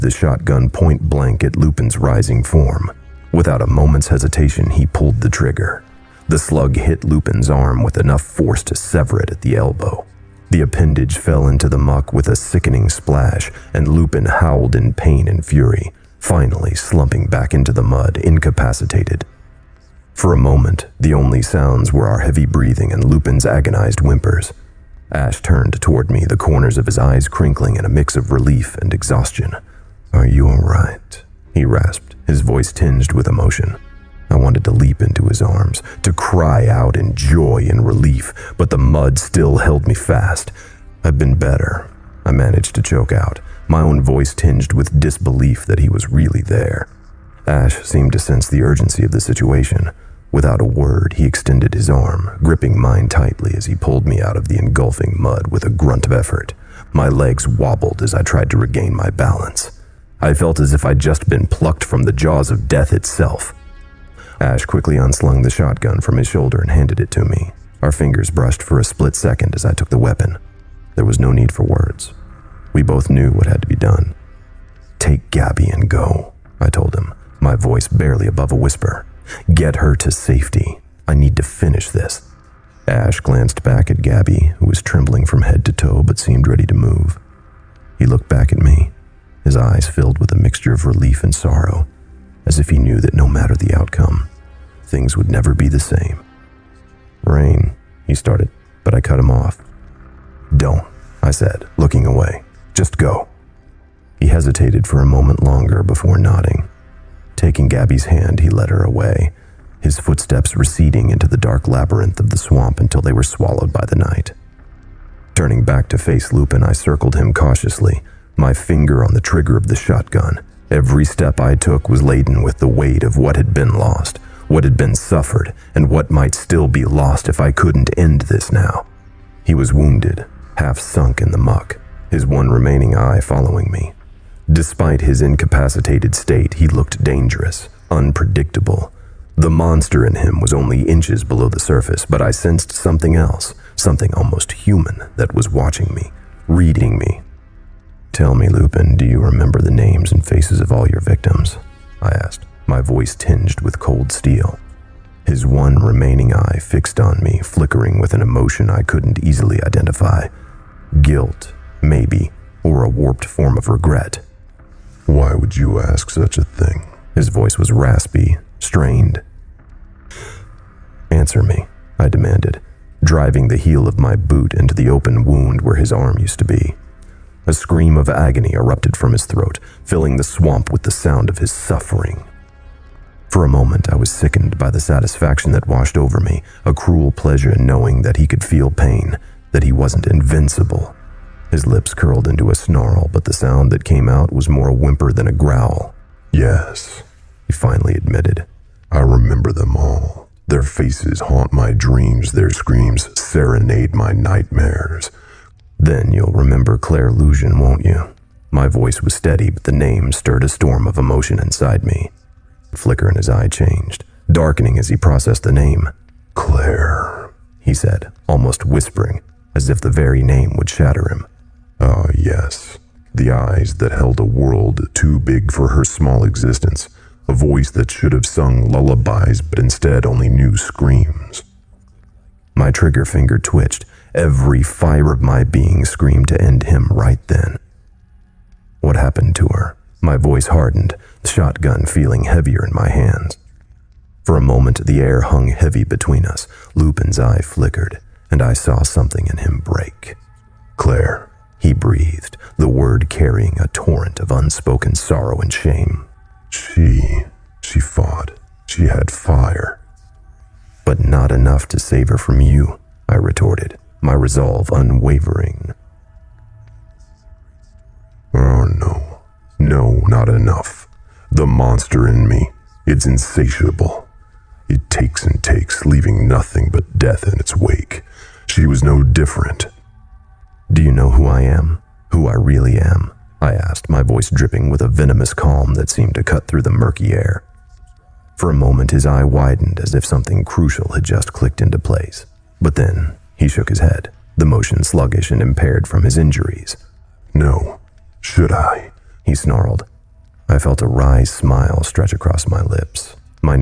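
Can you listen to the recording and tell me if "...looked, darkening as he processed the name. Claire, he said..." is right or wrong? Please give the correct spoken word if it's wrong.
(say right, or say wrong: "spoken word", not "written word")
wrong: "changed", not "looked".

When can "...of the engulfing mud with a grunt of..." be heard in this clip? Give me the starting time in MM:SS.
00:54.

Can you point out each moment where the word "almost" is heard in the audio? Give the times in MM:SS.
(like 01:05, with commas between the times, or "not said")
02:24, 03:38.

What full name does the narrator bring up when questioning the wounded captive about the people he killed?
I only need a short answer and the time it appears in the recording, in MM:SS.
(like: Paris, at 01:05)
Claire Lusion, at 03:26.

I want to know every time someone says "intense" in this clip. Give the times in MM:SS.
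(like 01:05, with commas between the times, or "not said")
not said.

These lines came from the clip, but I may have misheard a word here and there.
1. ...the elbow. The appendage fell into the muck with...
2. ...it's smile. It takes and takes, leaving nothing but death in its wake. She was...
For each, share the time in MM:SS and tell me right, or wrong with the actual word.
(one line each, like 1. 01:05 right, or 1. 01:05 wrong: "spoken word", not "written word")
1. 00:09 right
2. 04:32 wrong: "insatiable", not "smile".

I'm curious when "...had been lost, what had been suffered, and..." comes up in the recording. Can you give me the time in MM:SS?
02:03.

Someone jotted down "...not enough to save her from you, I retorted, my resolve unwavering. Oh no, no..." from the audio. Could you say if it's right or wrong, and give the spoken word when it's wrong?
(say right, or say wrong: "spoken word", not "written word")
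right.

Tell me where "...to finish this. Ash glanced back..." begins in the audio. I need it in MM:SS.
01:21.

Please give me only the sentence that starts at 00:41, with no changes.
I've been better, I managed to choke out my own voice tinged with disbelief that he was really there.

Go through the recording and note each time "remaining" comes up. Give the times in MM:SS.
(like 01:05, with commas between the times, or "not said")
02:12, 02:35.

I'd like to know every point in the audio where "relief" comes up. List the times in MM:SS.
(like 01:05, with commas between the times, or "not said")
00:28, 00:37, 01:30.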